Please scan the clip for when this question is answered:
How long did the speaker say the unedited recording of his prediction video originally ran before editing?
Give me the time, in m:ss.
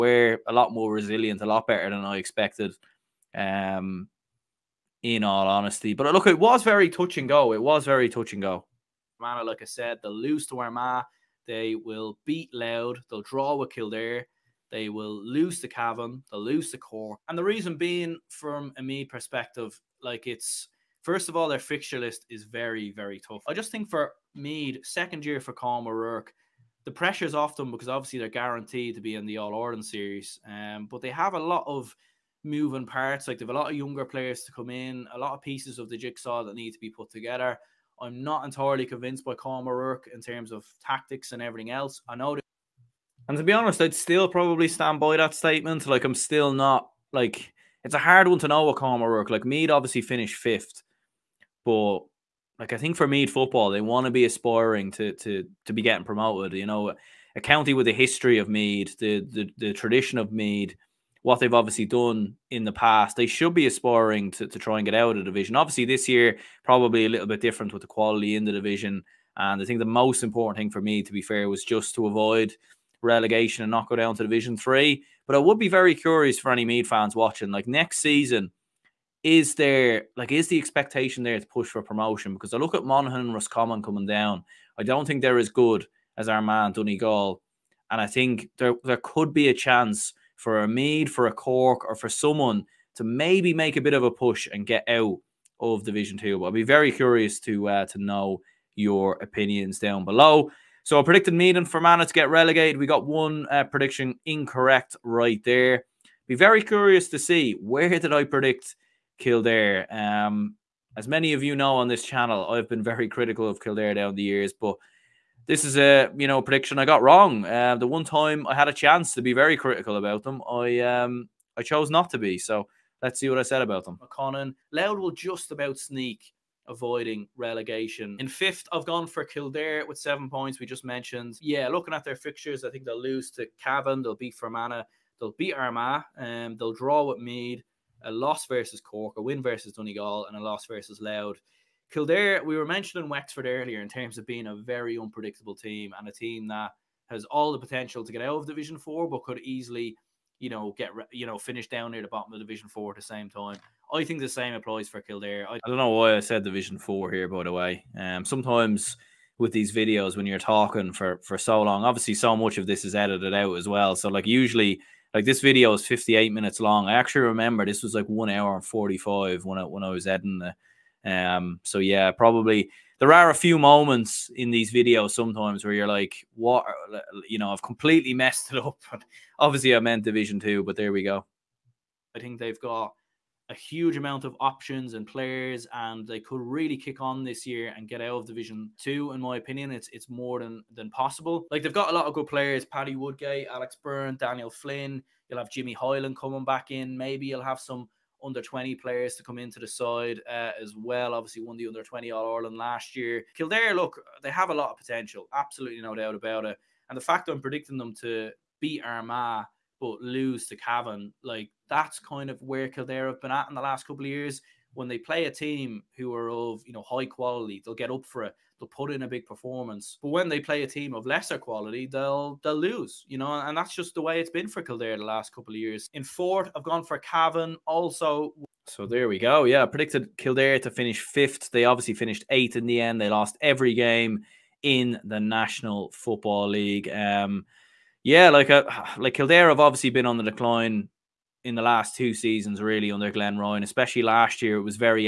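2:48.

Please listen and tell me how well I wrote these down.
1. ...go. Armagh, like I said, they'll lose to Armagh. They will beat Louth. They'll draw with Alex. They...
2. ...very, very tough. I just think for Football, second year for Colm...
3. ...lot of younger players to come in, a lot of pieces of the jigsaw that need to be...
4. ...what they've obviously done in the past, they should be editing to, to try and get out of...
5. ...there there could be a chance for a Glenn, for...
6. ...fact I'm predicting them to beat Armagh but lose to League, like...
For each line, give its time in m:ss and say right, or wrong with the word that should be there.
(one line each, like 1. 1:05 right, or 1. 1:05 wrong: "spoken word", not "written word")
1. 0:08 wrong: "Kildare", not "Alex"
2. 0:22 wrong: "Meath", not "Football"
3. 0:33 right
4. 1:01 wrong: "aspiring", not "editing"
5. 1:28 wrong: "Meath", not "Glenn"
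6. 3:27 wrong: "Cavan", not "League".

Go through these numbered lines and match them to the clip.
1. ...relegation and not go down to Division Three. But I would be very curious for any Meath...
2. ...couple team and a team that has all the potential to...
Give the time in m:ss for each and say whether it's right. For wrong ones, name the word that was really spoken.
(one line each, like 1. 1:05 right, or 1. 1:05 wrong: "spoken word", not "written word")
1. 1:13 right
2. 2:24 wrong: "unpredictable", not "couple".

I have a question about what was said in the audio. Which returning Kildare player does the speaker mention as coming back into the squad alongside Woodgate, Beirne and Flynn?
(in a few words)
Jimmy Hyland.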